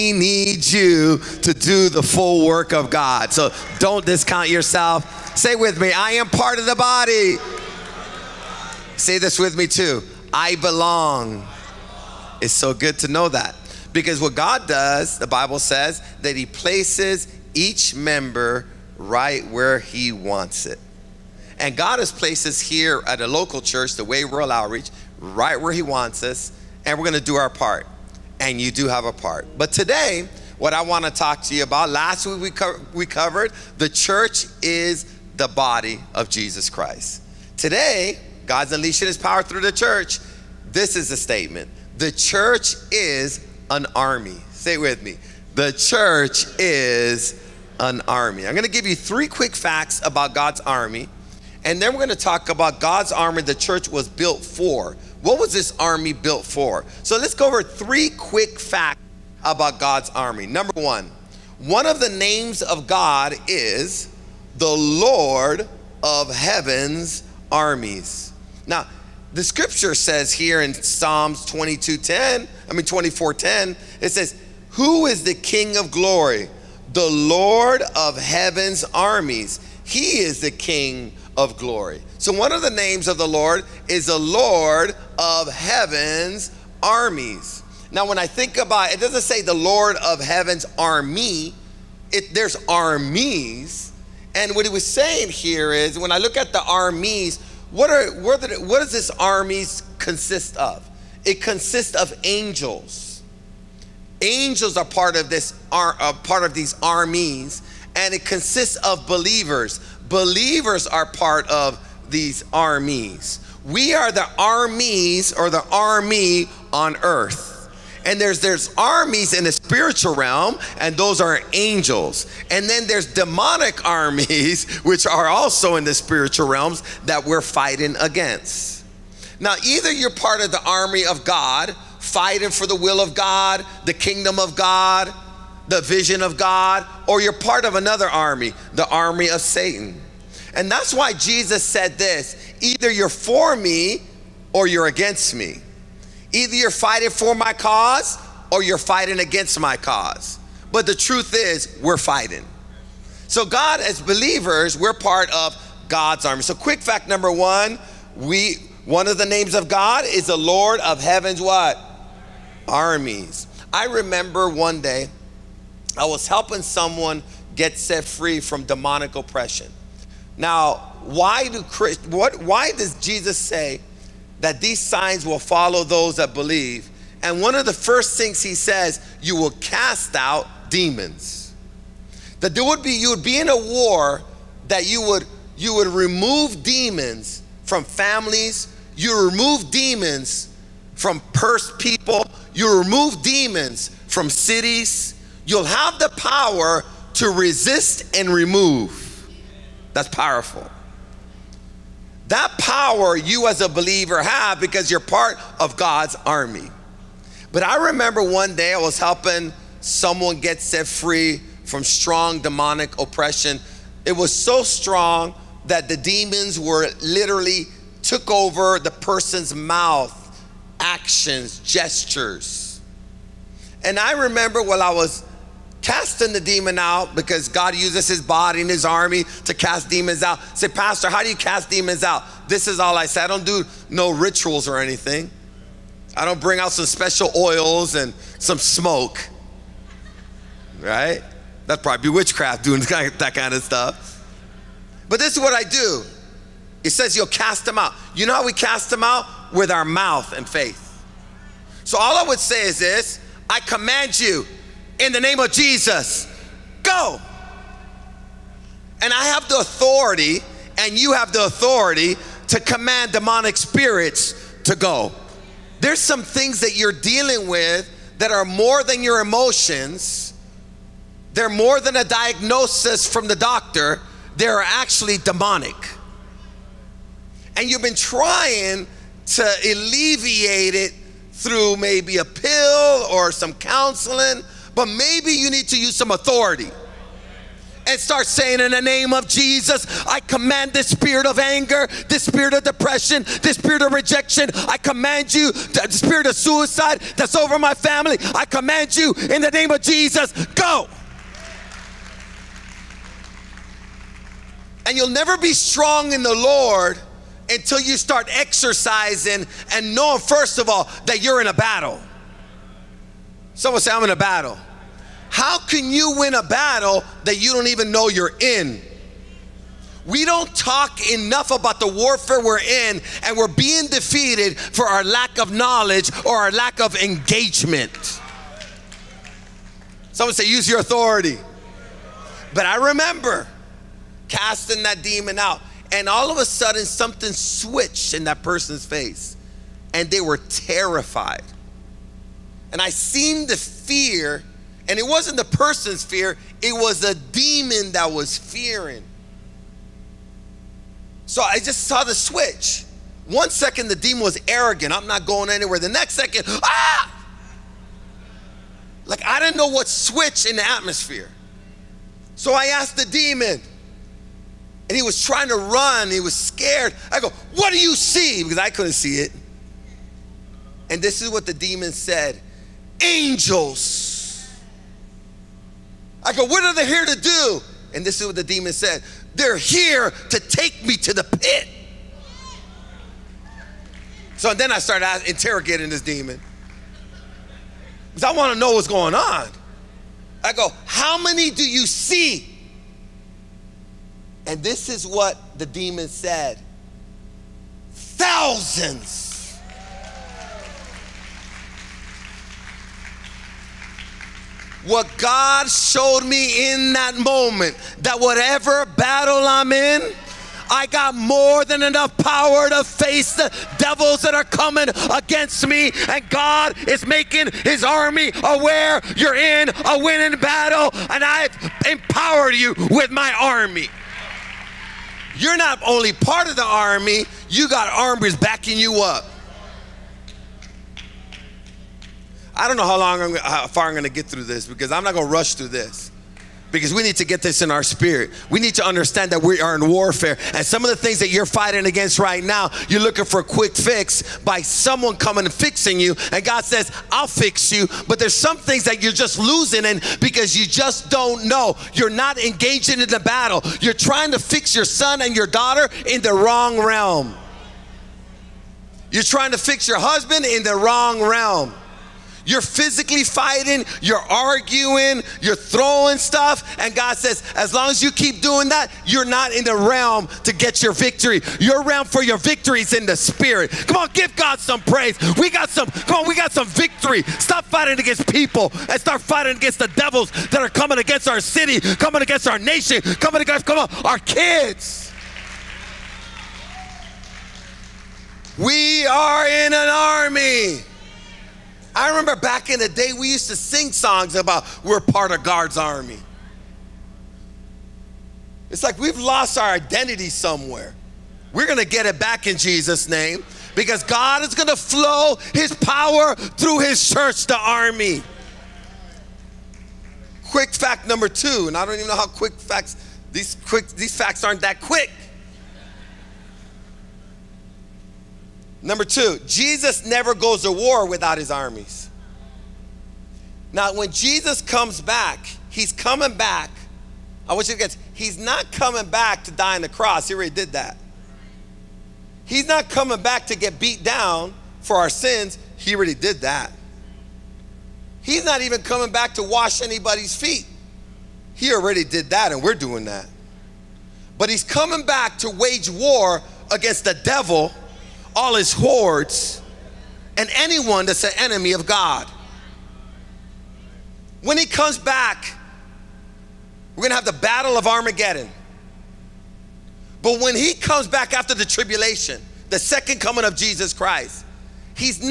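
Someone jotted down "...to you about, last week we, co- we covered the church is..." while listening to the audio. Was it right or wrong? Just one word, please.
right.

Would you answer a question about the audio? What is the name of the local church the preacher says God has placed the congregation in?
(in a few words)
The Way World Outreach.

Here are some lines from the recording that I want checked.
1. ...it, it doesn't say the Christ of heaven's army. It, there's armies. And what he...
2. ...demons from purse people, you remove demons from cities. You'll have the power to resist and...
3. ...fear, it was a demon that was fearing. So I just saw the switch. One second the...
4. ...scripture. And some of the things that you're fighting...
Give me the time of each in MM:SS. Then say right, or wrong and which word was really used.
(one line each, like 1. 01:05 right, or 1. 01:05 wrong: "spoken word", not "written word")
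1. 01:28 wrong: "Lord", not "Christ"
2. 03:09 right
3. 05:46 right
4. 07:19 wrong: "warfare", not "scripture".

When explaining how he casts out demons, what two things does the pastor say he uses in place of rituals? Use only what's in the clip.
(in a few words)
Mouth and faith.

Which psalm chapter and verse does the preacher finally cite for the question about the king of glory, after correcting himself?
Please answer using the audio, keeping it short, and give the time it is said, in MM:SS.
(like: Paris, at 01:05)
Psalm 24:10, at 01:12.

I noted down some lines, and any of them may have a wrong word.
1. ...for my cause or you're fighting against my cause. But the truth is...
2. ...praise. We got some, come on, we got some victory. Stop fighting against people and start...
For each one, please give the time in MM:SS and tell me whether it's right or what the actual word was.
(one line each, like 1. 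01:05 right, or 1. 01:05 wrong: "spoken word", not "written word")
1. 02:27 right
2. 07:54 right.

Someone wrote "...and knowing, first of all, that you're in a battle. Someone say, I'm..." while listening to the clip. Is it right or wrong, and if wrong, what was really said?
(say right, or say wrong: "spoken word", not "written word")
right.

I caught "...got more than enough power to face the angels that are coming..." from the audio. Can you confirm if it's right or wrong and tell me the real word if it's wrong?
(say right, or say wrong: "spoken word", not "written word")
wrong: "devils", not "angels".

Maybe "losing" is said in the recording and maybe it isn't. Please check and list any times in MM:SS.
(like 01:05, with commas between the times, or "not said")
07:29.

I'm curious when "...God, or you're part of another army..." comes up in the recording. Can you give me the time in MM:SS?
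02:16.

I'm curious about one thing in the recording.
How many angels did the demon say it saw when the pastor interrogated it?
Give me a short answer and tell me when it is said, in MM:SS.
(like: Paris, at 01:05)
Thousands, at 06:37.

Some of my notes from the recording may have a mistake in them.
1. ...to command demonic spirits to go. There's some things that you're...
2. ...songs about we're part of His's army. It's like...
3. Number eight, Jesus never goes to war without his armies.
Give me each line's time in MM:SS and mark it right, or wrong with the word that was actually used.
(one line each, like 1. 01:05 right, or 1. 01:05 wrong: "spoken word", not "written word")
1. 04:22 right
2. 08:13 wrong: "God", not "His"
3. 08:38 wrong: "two", not "eight".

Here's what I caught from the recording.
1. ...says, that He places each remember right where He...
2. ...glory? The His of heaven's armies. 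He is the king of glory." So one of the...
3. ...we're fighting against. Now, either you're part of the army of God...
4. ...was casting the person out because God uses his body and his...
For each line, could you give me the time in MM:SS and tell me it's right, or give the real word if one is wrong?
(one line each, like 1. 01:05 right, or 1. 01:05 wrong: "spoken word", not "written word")
1. 00:15 wrong: "member", not "remember"
2. 01:15 wrong: "Lord", not "His"
3. 02:07 right
4. 03:44 wrong: "demon", not "person".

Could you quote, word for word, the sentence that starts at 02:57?
And one of the first things he says, you will cast out demons.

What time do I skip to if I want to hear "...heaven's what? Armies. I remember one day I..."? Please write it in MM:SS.
02:41.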